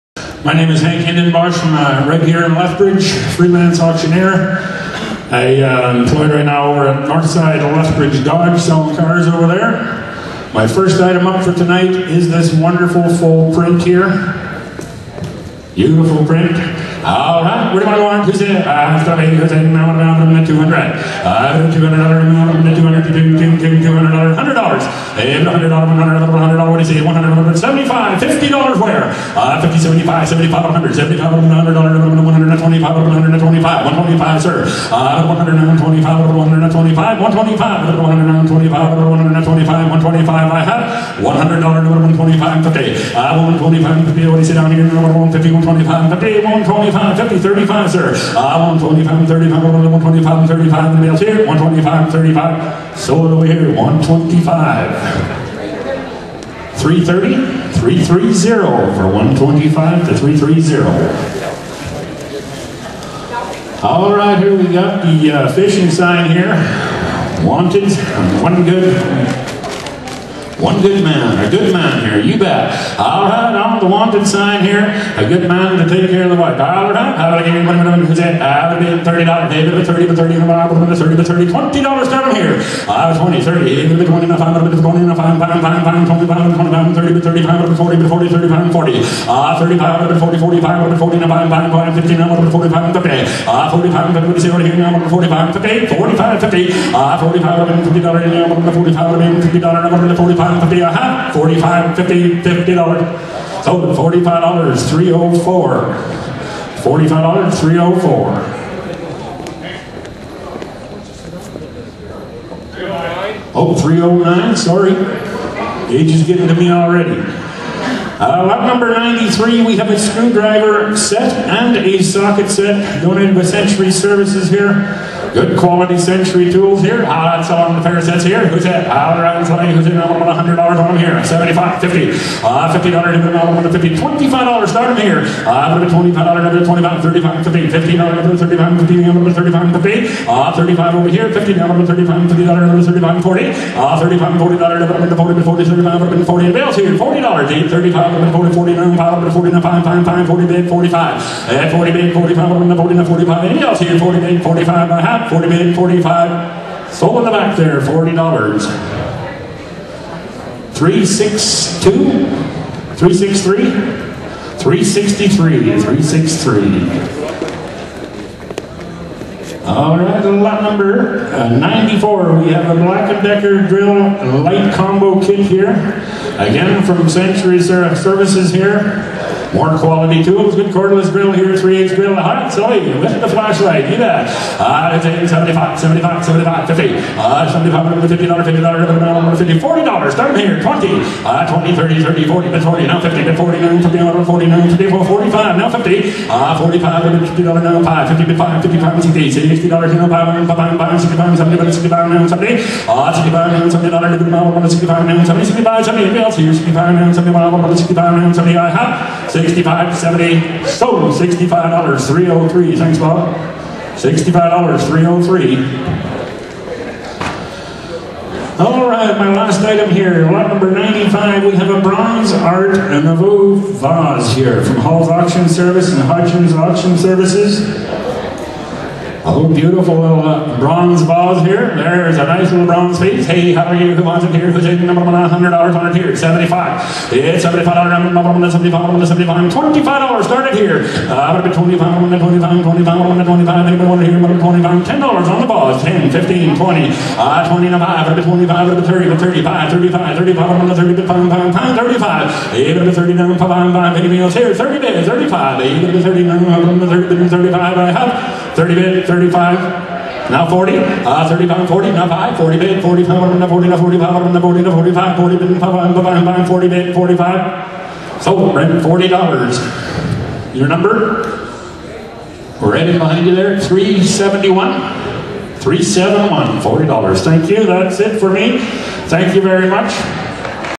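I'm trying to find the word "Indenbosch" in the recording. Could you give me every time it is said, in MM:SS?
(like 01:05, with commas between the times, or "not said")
00:01.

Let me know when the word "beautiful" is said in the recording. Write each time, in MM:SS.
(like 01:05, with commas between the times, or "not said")
00:15, 03:49.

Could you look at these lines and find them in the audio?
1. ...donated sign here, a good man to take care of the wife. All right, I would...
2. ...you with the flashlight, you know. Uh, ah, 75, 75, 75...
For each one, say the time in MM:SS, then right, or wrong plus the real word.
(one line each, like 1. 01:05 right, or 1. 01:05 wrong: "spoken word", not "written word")
1. 01:13 wrong: "wanted", not "donated"
2. 03:02 right.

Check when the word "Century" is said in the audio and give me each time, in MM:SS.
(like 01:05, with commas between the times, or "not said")
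02:03, 02:57.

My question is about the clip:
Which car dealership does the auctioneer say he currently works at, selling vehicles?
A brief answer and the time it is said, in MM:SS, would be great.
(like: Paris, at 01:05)
Northside Lethbridge Dodge, at 00:07.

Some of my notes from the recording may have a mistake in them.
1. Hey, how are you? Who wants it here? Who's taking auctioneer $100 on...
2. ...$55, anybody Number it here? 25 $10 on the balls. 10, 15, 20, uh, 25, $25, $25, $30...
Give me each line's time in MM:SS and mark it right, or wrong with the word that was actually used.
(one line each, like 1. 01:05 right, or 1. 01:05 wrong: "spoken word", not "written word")
1. 03:53 wrong: "number", not "auctioneer"
2. 04:03 wrong: "25", not "55".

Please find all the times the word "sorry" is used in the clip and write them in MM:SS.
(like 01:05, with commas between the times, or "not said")
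01:54.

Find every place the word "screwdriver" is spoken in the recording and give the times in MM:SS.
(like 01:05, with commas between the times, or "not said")
01:59.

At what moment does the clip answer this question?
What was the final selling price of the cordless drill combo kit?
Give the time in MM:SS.
03:30.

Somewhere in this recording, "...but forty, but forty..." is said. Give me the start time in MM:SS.
01:27.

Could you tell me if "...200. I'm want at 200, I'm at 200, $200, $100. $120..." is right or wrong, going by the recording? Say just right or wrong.
wrong.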